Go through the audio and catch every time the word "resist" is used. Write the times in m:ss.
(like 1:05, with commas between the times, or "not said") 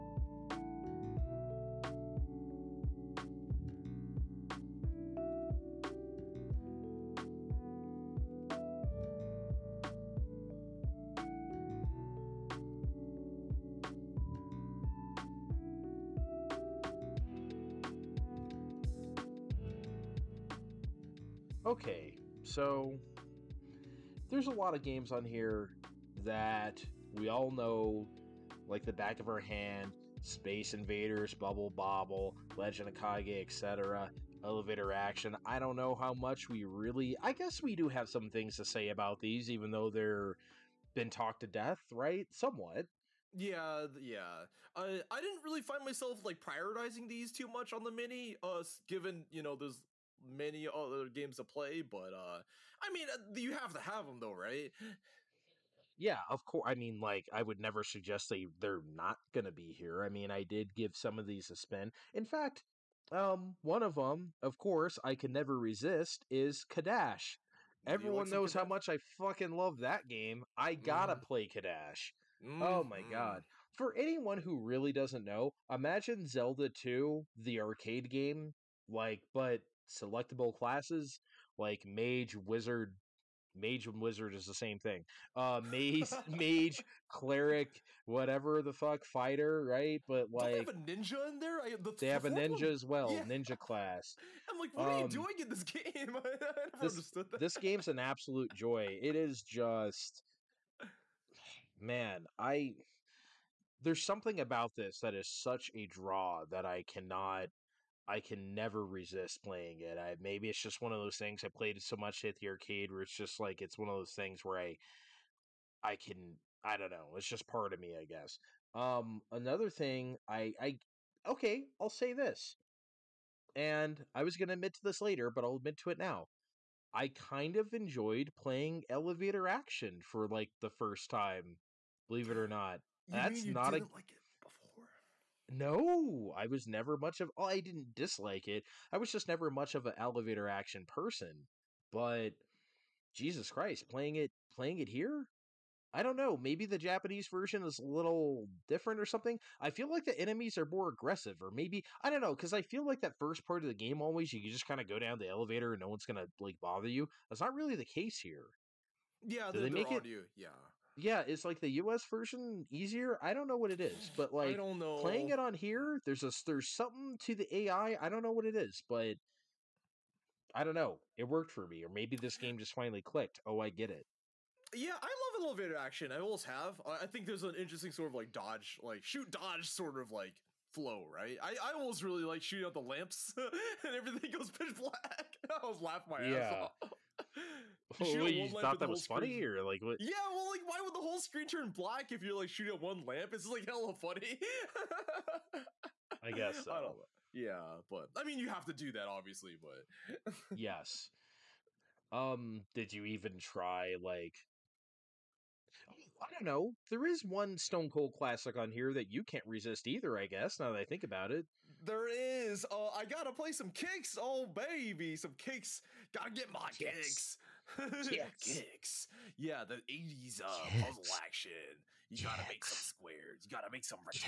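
1:05, 1:48, 3:29.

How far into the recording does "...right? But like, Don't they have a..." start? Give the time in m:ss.
1:29.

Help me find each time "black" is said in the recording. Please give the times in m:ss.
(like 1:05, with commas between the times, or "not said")
3:04, 3:11.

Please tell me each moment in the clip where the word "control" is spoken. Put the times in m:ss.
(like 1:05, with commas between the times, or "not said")
not said.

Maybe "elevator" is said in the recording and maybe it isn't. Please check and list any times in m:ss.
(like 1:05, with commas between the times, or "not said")
0:34, 2:08, 2:19, 2:35, 2:55.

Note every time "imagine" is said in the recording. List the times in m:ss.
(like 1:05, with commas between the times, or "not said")
1:15.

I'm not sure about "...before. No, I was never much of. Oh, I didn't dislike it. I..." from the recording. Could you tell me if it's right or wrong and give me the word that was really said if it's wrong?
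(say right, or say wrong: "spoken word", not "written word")
right.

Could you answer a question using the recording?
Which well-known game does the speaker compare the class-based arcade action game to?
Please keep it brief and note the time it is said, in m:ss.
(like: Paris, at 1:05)
Zelda 2, at 1:16.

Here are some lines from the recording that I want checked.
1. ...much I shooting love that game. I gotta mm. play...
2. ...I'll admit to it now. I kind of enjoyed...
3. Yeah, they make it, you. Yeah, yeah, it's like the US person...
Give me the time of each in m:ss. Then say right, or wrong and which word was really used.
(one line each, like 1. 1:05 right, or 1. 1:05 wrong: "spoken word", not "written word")
1. 1:08 wrong: "fucking", not "shooting"
2. 2:05 right
3. 2:39 wrong: "version", not "person".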